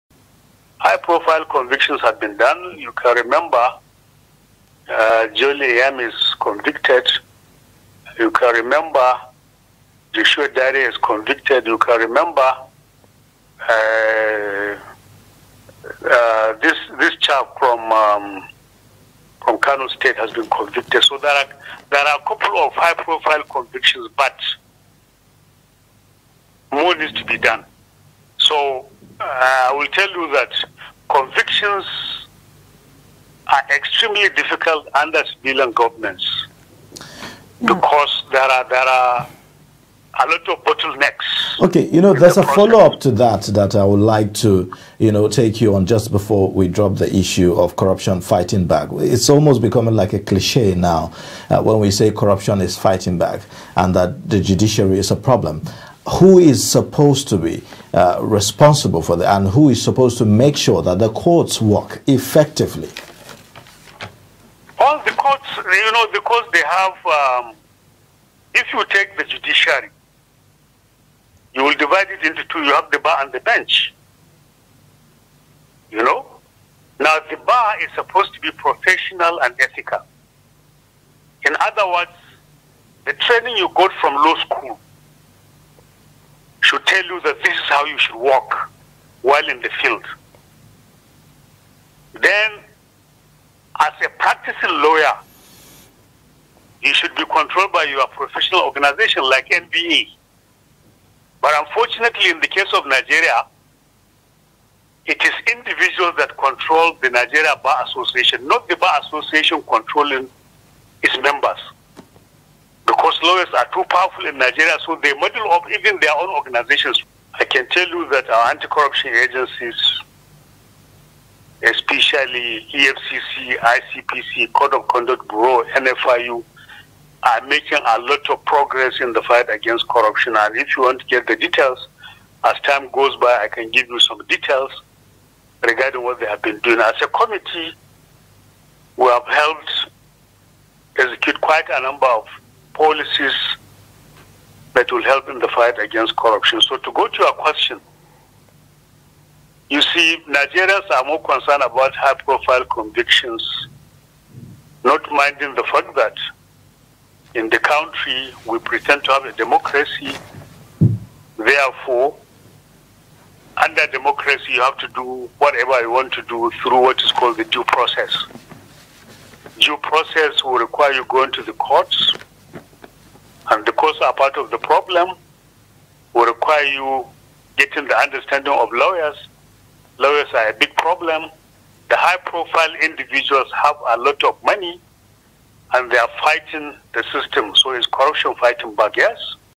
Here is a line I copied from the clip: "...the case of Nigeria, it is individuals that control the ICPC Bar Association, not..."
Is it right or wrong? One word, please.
wrong.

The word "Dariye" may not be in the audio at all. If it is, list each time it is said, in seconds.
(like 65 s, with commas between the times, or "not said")
10 s.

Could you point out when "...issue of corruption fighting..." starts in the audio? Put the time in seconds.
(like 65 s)
47 s.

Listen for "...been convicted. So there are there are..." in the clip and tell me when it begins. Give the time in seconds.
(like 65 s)
20 s.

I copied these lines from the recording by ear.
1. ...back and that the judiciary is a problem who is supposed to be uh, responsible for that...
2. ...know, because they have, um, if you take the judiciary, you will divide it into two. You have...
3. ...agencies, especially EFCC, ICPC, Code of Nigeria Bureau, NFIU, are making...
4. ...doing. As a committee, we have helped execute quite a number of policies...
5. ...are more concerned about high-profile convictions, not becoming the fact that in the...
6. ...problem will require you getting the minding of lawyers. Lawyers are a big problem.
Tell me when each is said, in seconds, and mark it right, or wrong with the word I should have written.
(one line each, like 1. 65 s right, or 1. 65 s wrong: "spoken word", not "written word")
1. 53 s right
2. 65 s right
3. 119 s wrong: "Conduct", not "Nigeria"
4. 136 s right
5. 150 s wrong: "minding", not "becoming"
6. 174 s wrong: "understanding", not "minding".